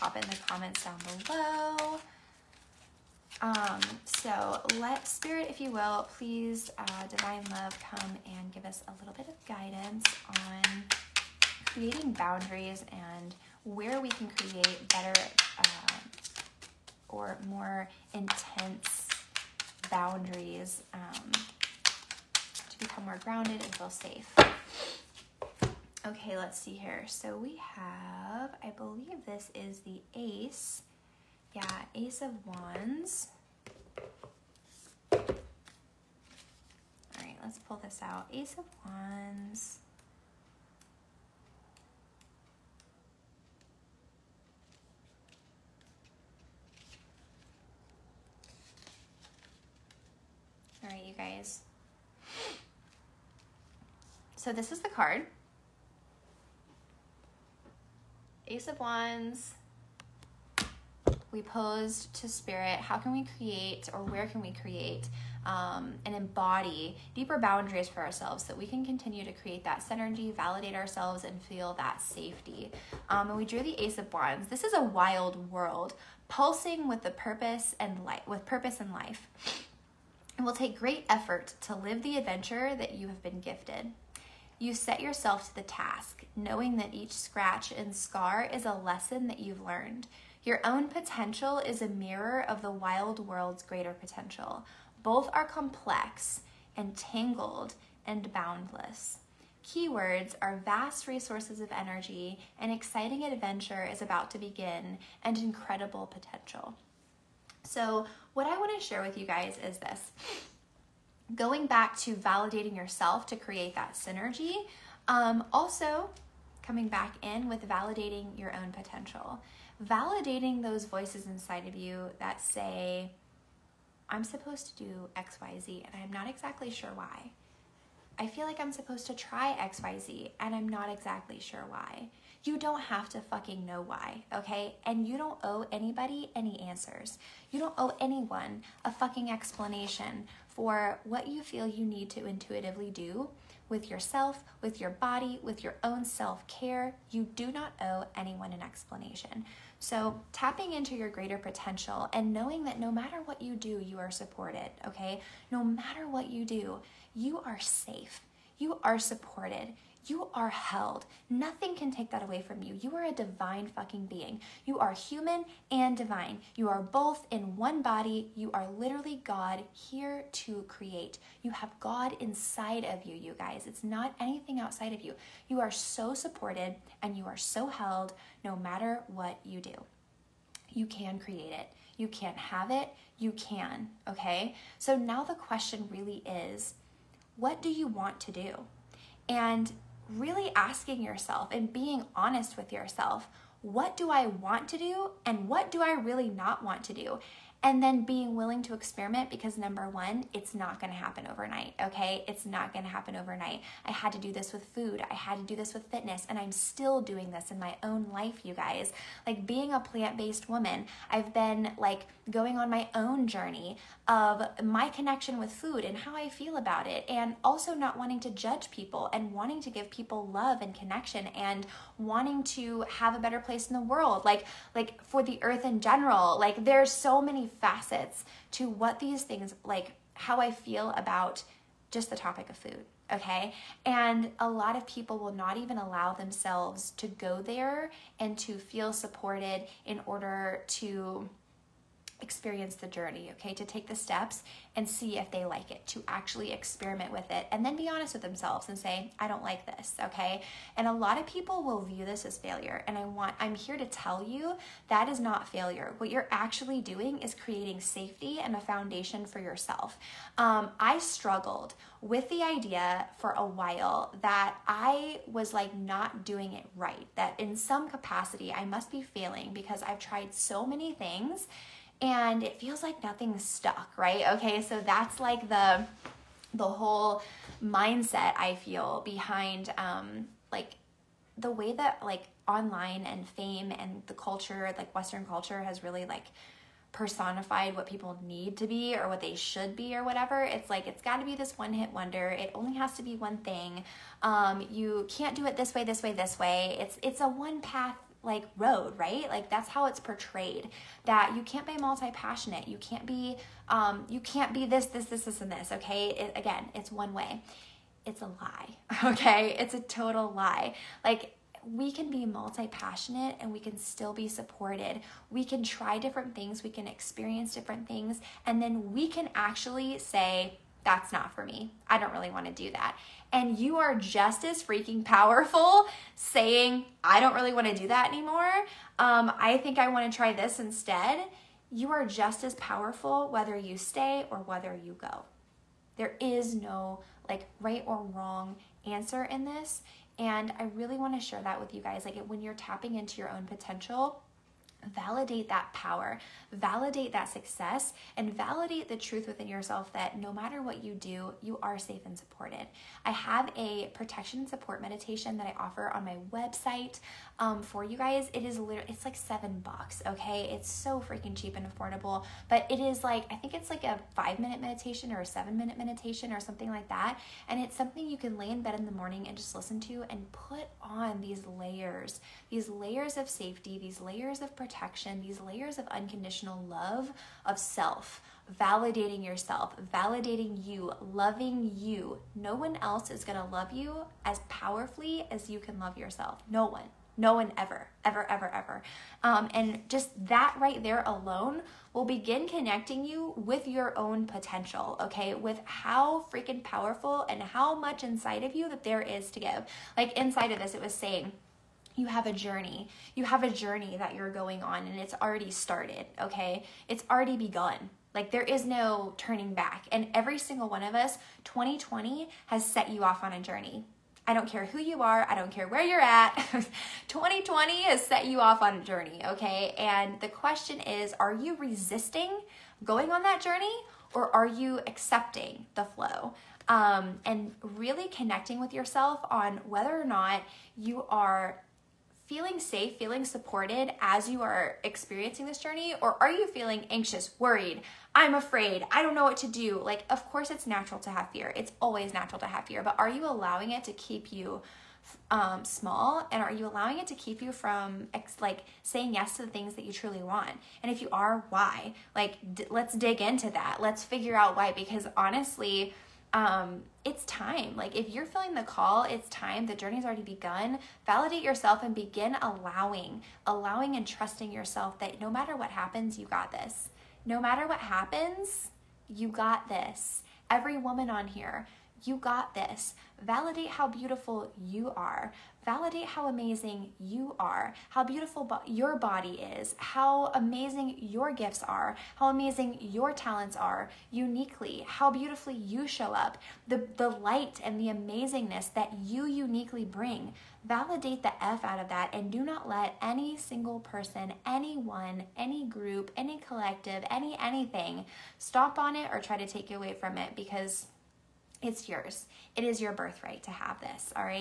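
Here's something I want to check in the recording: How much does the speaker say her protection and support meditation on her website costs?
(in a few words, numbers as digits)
$7.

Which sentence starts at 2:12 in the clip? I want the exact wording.
You don't have to fucking know why, okay?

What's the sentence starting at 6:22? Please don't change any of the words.
No one else is going to love you as powerfully as you can love yourself.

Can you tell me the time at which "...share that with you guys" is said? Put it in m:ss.
5:41.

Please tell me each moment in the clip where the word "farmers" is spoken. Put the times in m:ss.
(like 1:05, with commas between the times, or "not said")
not said.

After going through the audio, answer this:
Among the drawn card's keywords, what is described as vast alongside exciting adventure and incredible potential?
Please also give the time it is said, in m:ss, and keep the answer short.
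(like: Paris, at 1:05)
resources of energy, at 1:40.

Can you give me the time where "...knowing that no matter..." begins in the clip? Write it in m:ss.
2:32.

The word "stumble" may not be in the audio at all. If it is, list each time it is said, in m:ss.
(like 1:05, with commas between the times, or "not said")
not said.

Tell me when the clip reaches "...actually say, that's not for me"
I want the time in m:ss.
5:19.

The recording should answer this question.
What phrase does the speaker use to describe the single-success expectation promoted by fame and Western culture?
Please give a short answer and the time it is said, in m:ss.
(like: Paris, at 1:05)
one hit wonder, at 4:51.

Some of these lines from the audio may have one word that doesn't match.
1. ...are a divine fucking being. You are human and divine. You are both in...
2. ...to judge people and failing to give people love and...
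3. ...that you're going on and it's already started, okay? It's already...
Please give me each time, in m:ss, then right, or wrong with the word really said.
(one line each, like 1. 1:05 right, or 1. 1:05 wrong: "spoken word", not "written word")
1. 2:42 right
2. 3:38 wrong: "wanting", not "failing"
3. 6:43 right.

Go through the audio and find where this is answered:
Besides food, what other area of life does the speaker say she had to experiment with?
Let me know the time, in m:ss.
3:25.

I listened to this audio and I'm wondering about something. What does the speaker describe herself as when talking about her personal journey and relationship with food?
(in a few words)
plant based woman.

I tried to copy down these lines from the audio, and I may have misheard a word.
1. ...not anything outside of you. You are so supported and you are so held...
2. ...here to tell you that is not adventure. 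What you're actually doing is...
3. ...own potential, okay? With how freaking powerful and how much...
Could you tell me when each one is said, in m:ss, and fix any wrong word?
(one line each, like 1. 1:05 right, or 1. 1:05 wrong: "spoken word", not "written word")
1. 2:53 right
2. 4:13 wrong: "failure", not "adventure"
3. 6:33 right.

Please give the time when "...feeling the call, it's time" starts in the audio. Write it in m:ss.
7:38.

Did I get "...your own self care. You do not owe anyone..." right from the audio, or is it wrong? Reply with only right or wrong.
right.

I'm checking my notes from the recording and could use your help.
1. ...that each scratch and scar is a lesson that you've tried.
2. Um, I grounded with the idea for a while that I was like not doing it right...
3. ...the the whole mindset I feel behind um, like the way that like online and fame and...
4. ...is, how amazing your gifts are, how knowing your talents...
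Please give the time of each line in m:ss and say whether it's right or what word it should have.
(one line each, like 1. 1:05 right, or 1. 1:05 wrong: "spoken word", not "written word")
1. 1:26 wrong: "learned", not "tried"
2. 4:20 wrong: "struggled", not "grounded"
3. 4:35 right
4. 7:59 wrong: "amazing", not "knowing".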